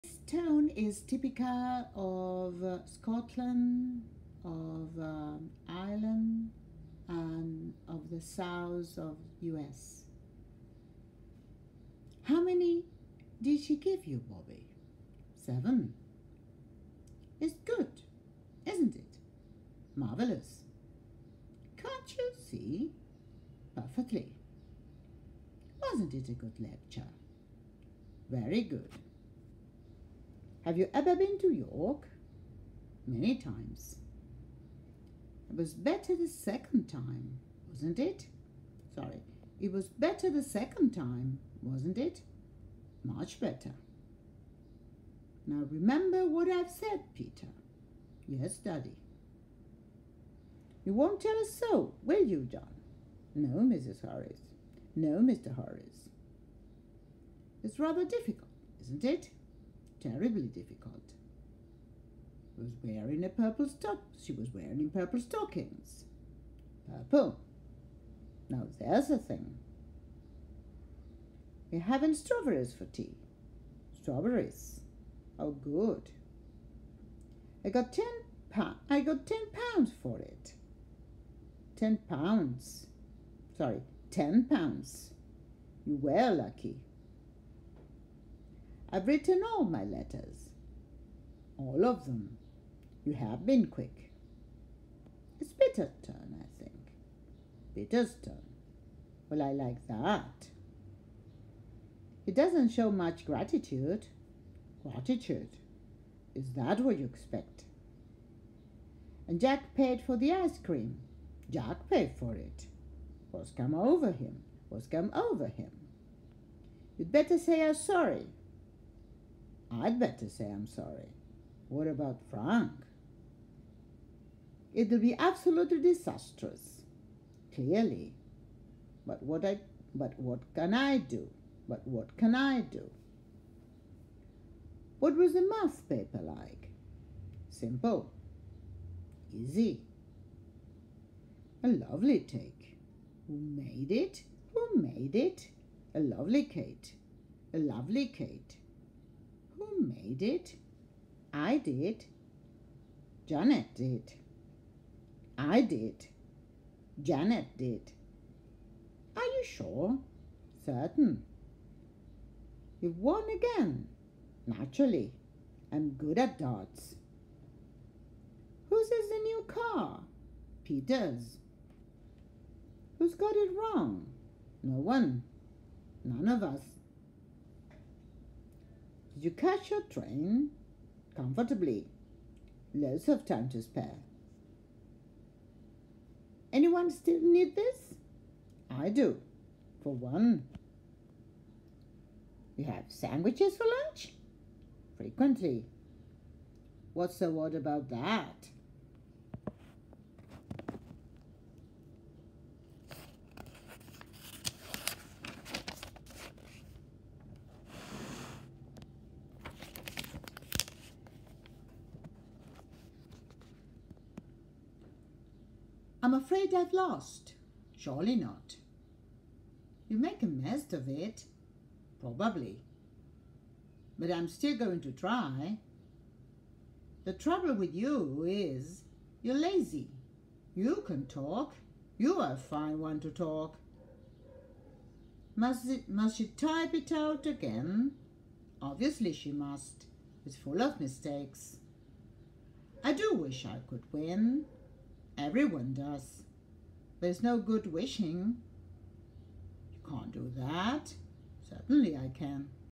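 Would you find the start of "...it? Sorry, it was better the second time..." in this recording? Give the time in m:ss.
0:37.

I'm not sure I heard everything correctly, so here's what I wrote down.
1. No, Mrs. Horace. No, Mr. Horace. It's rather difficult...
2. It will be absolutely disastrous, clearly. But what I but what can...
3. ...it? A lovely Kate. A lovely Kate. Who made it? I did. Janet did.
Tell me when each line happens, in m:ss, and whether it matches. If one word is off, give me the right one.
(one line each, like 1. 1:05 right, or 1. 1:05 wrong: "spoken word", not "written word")
1. 0:53 right
2. 2:04 right
3. 2:25 right.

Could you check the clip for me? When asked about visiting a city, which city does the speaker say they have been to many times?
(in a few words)
York.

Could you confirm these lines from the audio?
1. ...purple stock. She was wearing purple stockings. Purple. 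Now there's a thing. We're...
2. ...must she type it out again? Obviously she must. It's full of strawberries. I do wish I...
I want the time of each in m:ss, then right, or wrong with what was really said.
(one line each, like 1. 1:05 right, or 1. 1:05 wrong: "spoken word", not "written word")
1. 1:03 right
2. 3:55 wrong: "mistakes", not "strawberries".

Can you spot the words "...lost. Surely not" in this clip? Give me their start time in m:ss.
3:36.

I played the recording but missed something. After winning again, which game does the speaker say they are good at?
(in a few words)
darts.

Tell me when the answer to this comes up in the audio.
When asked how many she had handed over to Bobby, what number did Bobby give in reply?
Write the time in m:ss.
0:15.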